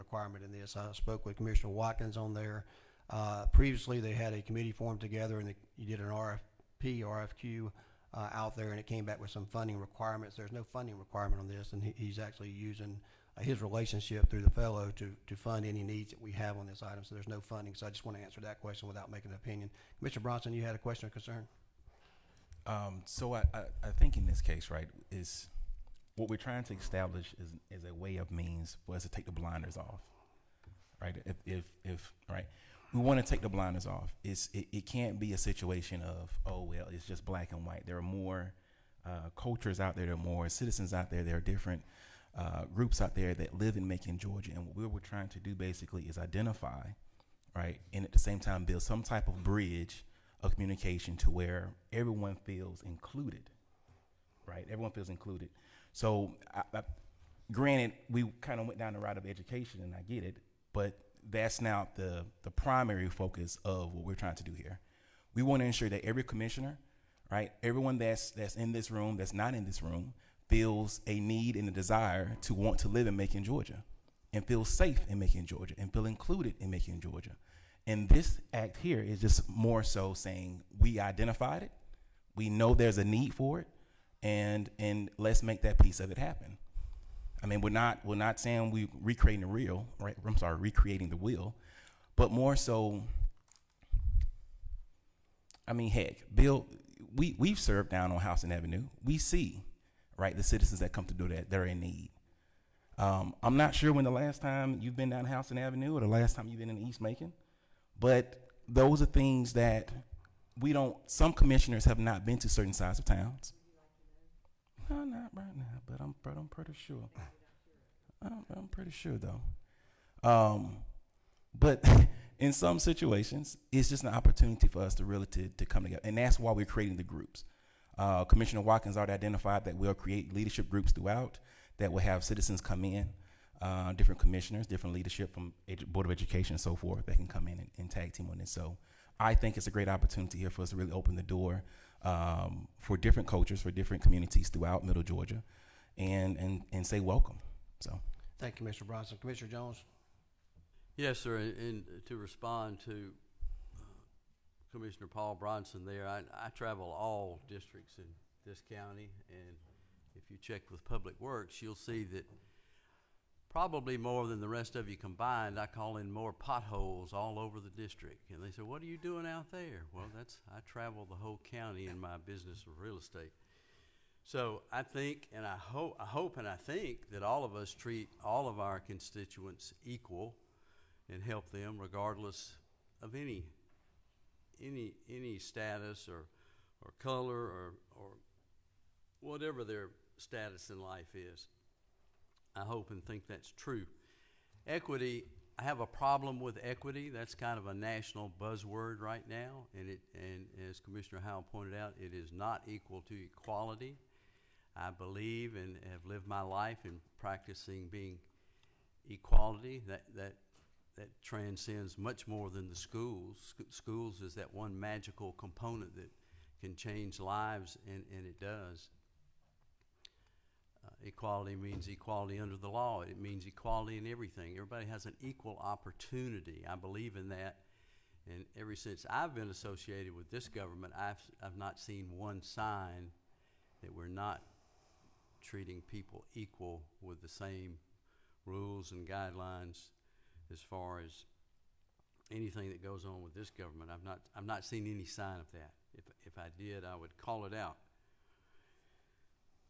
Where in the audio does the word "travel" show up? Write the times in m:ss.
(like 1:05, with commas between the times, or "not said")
2:36, 2:50.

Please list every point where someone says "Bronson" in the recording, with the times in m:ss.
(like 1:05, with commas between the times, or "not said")
0:20, 2:28, 2:35.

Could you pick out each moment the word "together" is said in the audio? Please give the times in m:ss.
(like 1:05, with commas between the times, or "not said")
0:04, 2:05.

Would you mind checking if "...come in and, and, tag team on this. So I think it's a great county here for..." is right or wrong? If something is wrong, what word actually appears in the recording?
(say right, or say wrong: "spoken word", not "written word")
wrong: "opportunity", not "county".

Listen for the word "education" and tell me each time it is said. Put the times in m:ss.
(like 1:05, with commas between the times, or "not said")
0:59, 2:16.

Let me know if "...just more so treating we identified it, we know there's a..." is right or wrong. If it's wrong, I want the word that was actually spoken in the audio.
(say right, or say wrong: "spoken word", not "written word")
wrong: "saying", not "treating".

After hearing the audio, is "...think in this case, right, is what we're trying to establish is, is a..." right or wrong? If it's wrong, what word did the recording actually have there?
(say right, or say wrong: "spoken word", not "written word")
right.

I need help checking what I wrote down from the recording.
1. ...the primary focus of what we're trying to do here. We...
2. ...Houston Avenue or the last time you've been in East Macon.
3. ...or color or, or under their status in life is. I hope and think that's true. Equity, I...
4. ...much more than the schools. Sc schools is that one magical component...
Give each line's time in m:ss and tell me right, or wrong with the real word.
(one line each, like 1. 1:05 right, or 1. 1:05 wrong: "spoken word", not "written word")
1. 1:02 right
2. 1:45 right
3. 3:06 wrong: "whatever", not "under"
4. 3:31 right.